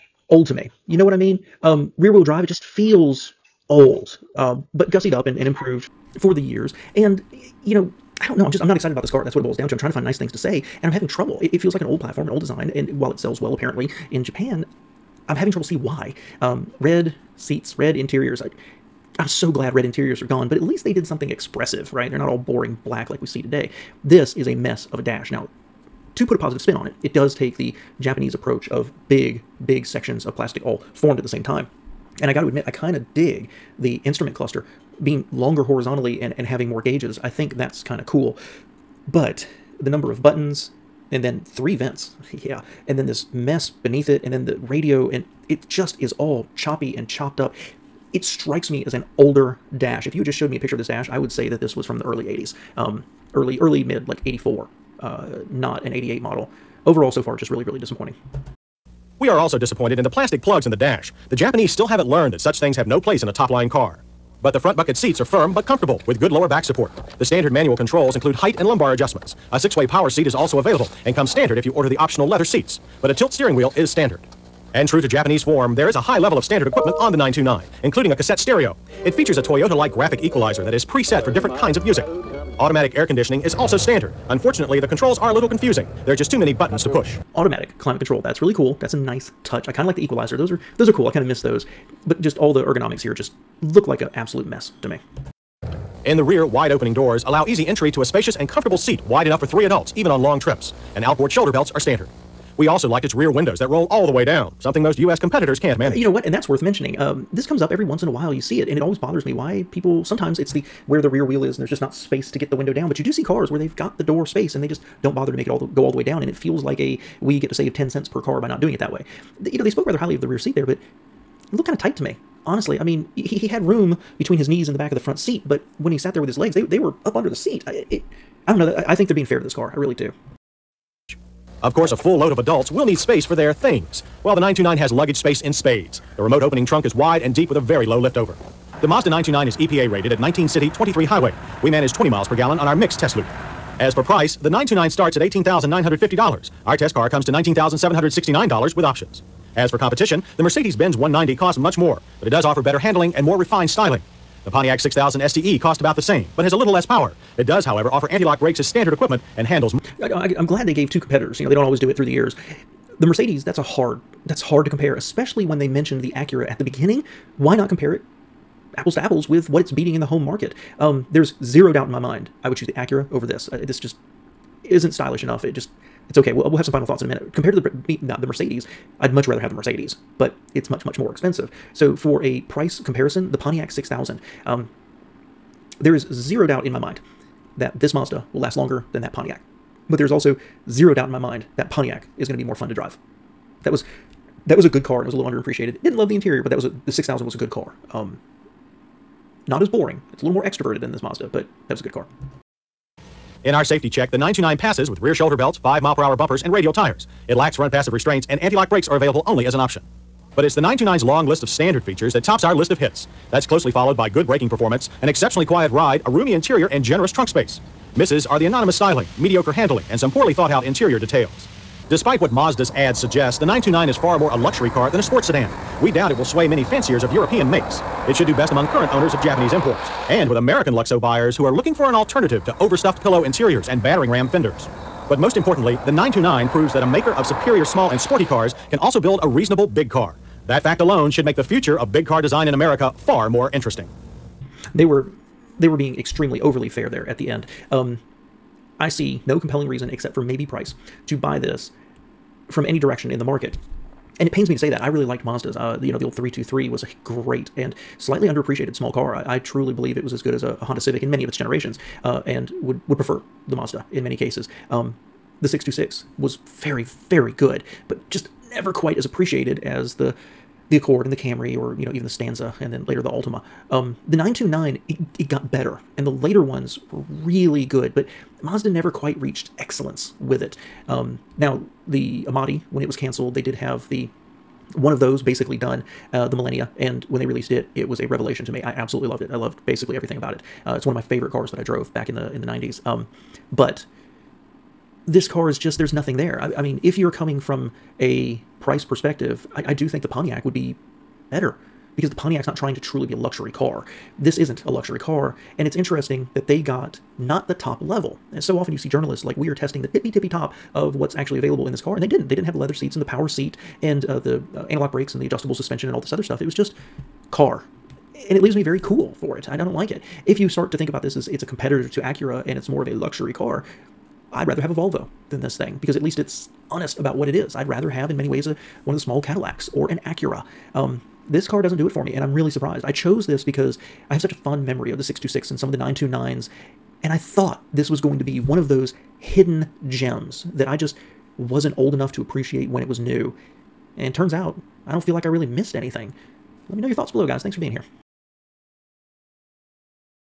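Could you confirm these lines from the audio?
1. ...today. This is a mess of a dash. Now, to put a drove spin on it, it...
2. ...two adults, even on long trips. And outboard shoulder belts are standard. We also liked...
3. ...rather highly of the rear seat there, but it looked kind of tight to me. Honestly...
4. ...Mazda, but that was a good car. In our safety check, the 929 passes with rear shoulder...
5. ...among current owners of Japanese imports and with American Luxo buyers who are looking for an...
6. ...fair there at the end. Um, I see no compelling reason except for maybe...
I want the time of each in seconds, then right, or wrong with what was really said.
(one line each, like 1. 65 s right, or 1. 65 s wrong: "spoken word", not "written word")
1. 23 s wrong: "positive", not "drove"
2. 99 s wrong: "three", not "two"
3. 119 s right
4. 201 s right
5. 228 s right
6. 246 s right.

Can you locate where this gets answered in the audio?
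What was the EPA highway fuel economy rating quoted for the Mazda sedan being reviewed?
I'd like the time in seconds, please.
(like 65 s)
140 s.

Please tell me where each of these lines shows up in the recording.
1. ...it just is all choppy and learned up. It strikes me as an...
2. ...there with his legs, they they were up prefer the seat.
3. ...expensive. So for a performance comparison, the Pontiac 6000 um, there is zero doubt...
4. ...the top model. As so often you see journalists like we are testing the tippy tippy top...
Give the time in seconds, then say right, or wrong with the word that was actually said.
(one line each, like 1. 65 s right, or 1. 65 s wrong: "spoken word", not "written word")
1. 45 s wrong: "chopped", not "learned"
2. 126 s wrong: "under", not "prefer"
3. 181 s wrong: "price", not "performance"
4. 307 s wrong: "level", not "model".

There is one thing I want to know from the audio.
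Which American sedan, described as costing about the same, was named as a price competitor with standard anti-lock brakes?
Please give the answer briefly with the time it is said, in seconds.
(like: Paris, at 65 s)
Pontiac 6000 STE, at 154 s.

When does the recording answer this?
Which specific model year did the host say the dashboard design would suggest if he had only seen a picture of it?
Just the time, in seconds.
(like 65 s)
54 s.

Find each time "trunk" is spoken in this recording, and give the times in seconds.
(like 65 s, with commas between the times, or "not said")
136 s, 217 s.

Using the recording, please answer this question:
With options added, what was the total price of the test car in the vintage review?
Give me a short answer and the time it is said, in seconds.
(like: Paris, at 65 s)
$19,769, at 147 s.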